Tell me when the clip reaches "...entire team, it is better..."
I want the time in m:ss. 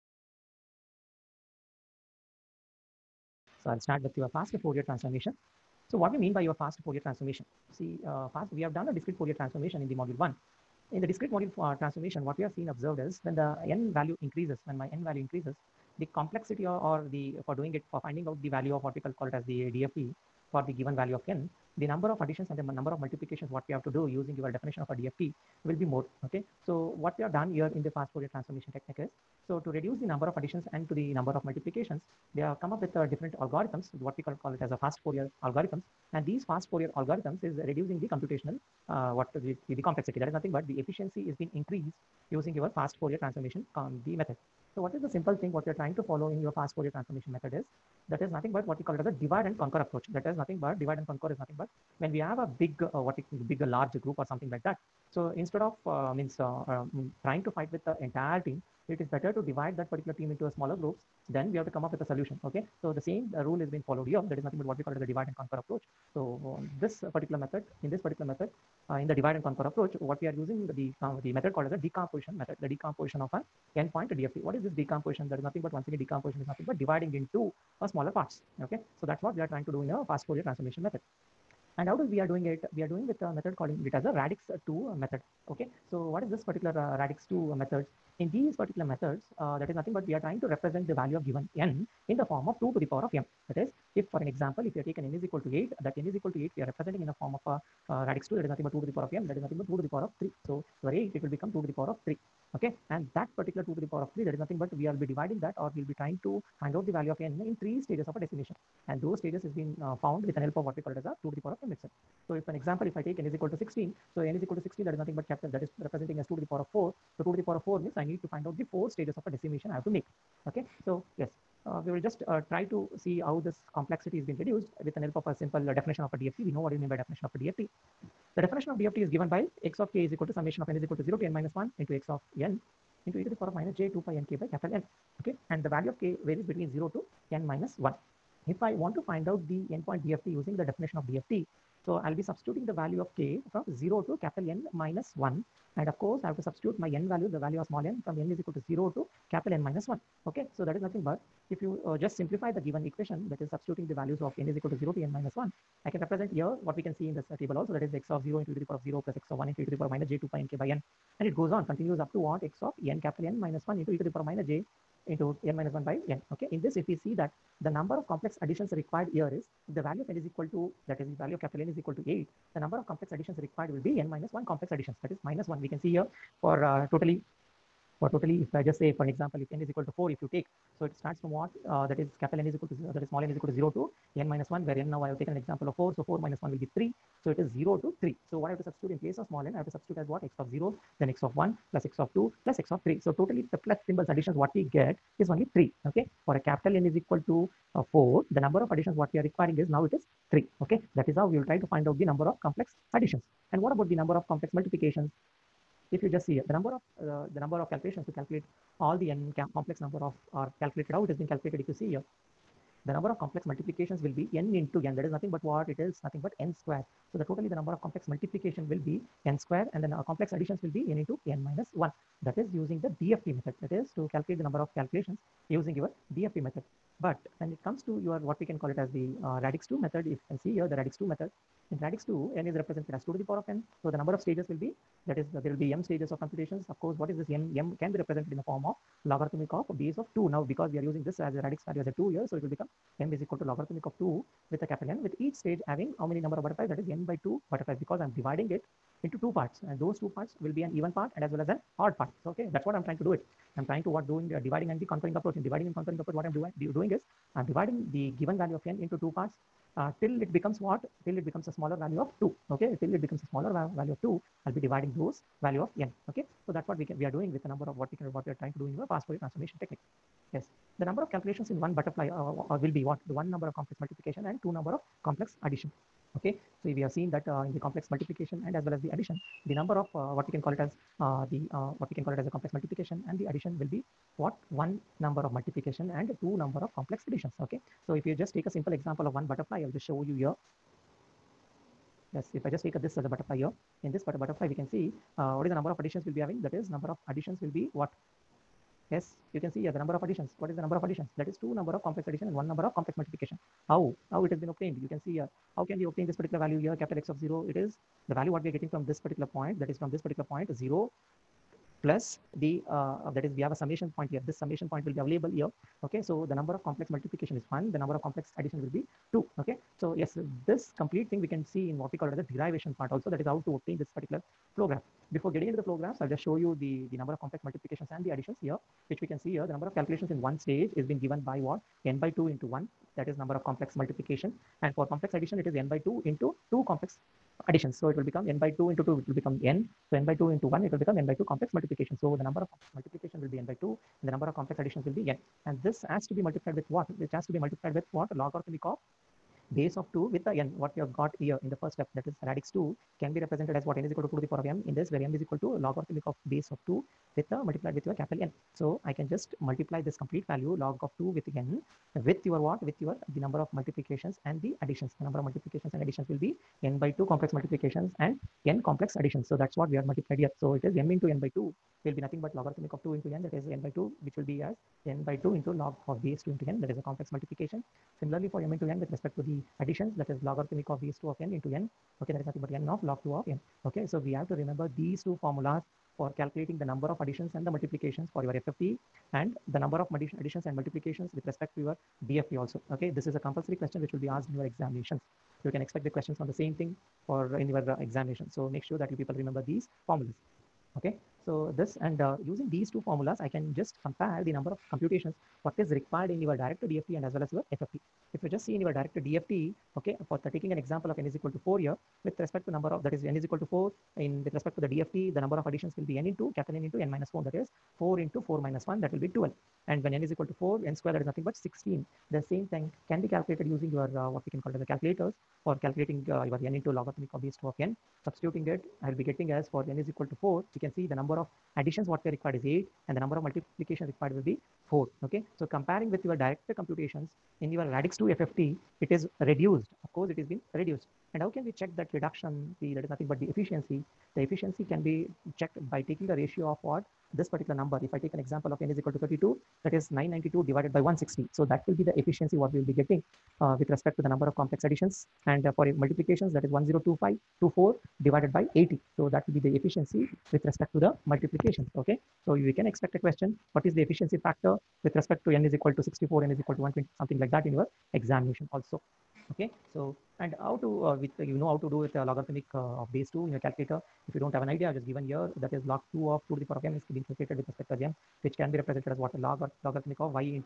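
0:58.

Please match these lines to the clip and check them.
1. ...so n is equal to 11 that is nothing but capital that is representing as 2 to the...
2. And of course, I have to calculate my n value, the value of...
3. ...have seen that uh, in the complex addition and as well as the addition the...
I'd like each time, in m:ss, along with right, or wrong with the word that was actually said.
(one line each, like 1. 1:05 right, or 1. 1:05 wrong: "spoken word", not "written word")
1. 1:54 wrong: "16", not "11"
2. 2:25 wrong: "substitute", not "calculate"
3. 4:36 wrong: "multiplication", not "addition".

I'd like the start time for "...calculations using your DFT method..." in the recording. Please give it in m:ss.
3:44.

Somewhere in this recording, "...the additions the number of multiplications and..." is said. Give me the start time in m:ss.
6:04.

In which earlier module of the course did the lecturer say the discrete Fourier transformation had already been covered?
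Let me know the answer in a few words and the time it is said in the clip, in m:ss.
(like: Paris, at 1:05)
module 1, at 0:09.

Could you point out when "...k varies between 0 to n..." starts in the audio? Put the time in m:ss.
2:16.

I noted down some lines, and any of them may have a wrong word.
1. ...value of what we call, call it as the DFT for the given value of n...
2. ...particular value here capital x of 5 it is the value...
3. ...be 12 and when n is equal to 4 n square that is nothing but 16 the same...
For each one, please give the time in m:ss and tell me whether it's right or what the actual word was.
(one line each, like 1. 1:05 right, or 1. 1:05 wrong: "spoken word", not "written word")
1. 0:18 right
2. 5:06 wrong: "0", not "5"
3. 6:59 right.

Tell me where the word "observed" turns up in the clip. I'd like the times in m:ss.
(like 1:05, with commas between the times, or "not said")
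0:12.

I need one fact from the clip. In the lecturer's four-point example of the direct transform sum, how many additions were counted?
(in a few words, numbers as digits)
3.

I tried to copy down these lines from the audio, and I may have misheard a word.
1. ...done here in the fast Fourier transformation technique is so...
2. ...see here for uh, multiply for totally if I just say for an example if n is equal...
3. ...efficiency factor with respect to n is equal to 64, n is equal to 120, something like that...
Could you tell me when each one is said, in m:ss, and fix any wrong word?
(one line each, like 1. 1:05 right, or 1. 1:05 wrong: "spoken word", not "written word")
1. 0:27 right
2. 2:55 wrong: "totally", not "multiply"
3. 7:43 right.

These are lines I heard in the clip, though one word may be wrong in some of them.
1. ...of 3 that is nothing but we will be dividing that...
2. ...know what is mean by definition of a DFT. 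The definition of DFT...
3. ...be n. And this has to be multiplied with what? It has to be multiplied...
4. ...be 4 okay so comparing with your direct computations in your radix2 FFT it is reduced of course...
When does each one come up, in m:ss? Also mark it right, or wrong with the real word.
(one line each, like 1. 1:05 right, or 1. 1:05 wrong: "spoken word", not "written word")
1. 1:44 right
2. 2:06 right
3. 5:44 right
4. 7:14 right.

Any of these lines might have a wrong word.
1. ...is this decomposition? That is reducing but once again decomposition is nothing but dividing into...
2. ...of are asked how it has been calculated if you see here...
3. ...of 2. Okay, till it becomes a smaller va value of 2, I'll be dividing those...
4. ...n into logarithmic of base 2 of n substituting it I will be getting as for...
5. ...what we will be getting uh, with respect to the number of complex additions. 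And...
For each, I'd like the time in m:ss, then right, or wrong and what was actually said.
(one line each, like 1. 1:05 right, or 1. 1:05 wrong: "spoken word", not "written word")
1. 1:14 wrong: "nothing", not "reducing"
2. 3:30 wrong: "calculated", not "asked"
3. 4:21 right
4. 7:06 right
5. 7:32 right.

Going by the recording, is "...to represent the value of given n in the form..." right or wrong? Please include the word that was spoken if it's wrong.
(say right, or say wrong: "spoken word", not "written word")
right.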